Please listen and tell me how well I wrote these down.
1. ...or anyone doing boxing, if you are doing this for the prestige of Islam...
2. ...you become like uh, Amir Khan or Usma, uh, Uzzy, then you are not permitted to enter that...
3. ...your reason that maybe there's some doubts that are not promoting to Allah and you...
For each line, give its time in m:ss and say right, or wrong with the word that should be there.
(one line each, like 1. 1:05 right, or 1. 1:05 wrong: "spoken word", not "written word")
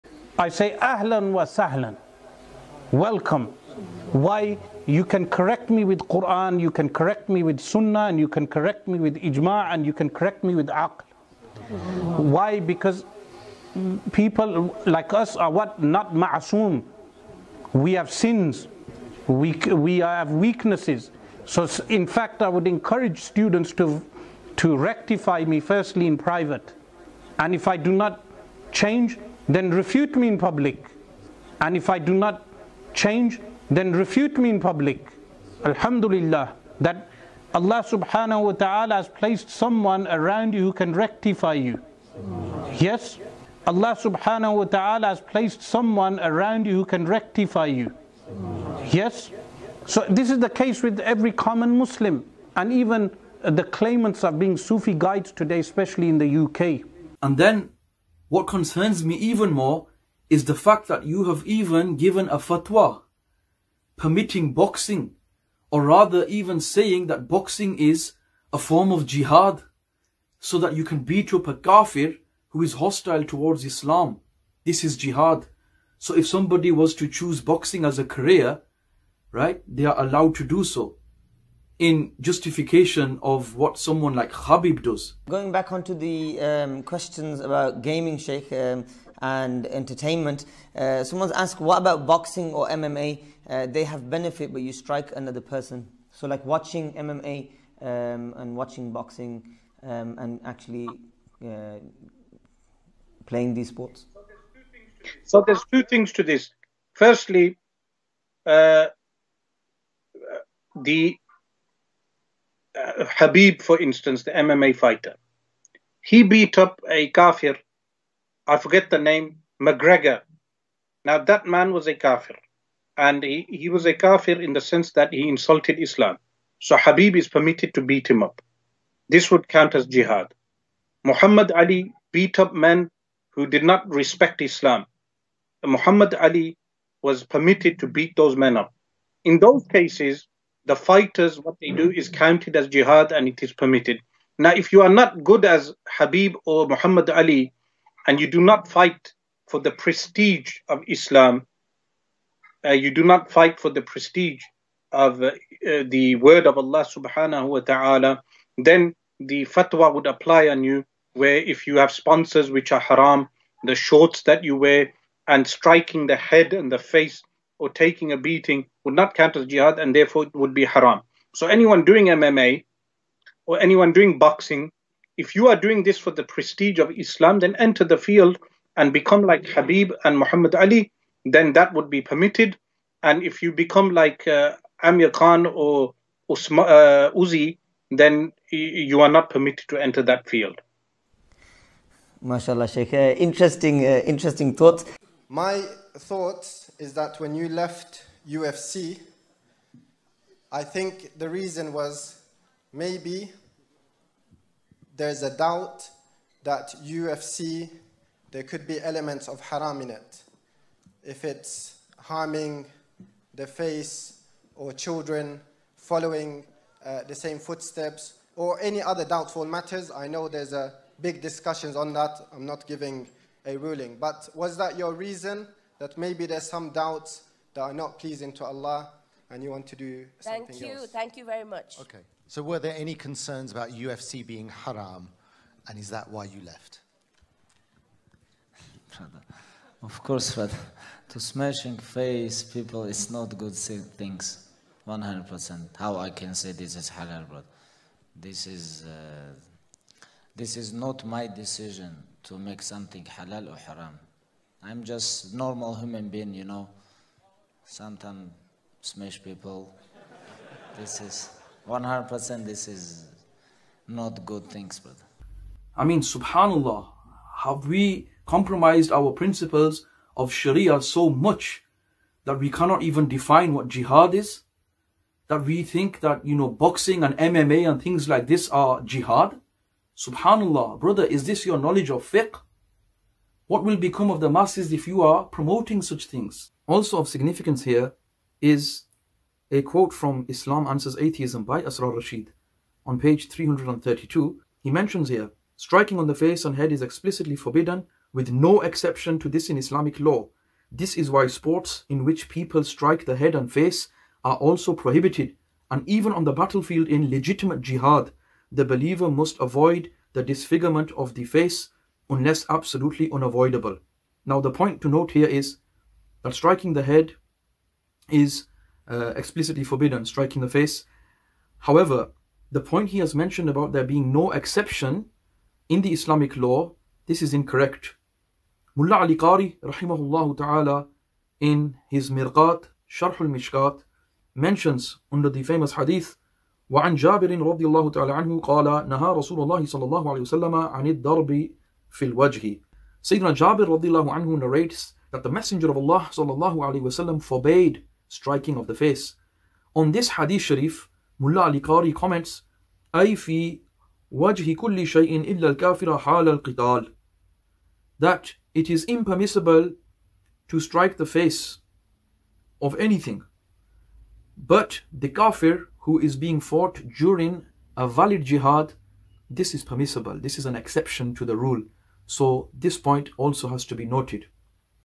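1. 2:53 right
2. 3:03 right
3. 3:44 wrong: "pleasing", not "promoting".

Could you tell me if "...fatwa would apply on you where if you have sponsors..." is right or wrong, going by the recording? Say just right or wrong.
right.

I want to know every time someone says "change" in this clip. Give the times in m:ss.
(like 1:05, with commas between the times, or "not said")
0:28, 0:32.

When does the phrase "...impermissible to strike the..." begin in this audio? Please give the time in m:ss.
5:58.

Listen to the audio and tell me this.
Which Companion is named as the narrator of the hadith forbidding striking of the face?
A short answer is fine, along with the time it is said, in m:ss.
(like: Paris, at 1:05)
Jabir, at 5:43.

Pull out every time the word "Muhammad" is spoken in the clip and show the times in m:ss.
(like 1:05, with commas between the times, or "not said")
2:11, 2:15, 2:26, 3:00.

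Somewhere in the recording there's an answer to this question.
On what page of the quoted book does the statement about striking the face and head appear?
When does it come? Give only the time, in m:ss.
4:53.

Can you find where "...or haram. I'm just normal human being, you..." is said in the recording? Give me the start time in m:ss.
4:13.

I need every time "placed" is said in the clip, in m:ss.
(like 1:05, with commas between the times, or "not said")
0:39, 0:45.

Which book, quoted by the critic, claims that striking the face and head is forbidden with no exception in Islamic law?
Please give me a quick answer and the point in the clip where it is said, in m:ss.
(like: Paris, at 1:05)
Islam Answers Atheism, at 4:50.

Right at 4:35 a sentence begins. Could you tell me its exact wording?
That we think that, you know, boxing and MMA and things like this are jihad?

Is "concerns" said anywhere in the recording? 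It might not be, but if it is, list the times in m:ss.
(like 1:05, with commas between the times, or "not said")
0:58, 3:52.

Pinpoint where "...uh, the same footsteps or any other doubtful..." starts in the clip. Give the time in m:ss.
3:36.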